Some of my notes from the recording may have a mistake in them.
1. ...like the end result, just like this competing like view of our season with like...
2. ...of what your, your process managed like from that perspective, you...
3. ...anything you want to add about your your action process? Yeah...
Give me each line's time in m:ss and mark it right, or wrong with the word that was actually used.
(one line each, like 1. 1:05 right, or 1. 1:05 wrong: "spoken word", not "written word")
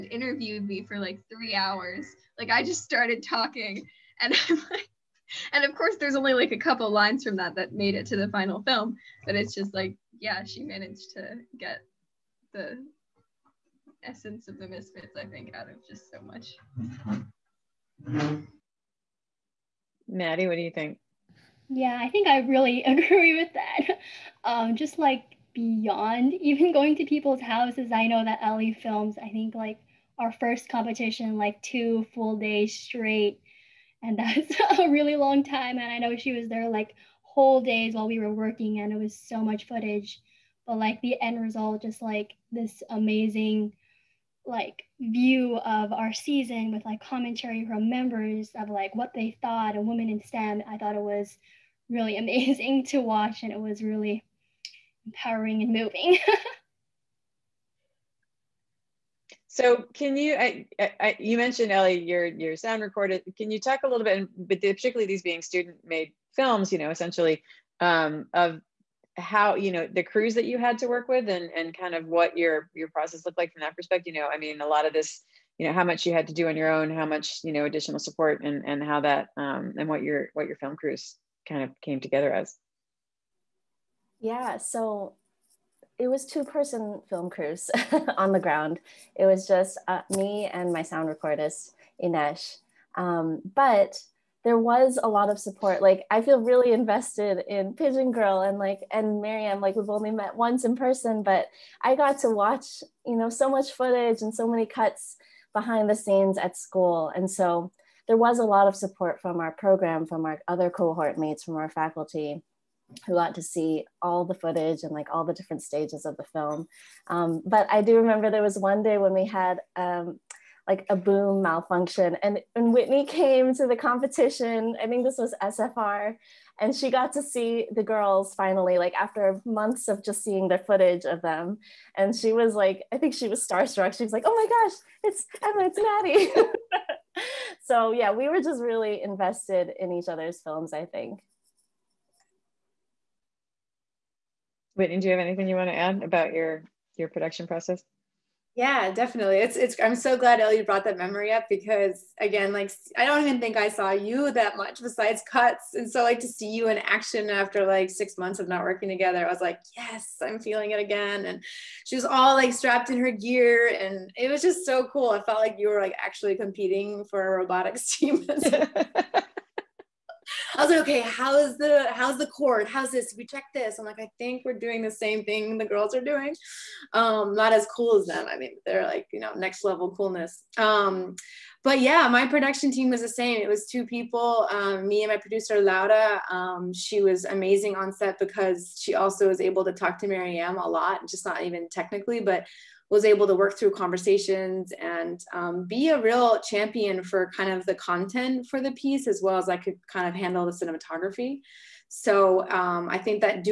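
1. 0:40 wrong: "amazing", not "competing"
2. 1:11 wrong: "looked", not "managed"
3. 2:25 wrong: "production", not "action".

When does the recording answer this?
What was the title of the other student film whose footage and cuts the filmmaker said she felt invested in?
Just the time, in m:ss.
1:37.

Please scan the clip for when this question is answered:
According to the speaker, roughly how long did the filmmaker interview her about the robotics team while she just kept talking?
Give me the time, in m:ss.
0:01.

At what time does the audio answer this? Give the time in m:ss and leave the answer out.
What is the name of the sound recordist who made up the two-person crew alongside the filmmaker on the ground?
1:32.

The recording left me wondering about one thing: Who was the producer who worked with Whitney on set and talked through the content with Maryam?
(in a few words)
Laura.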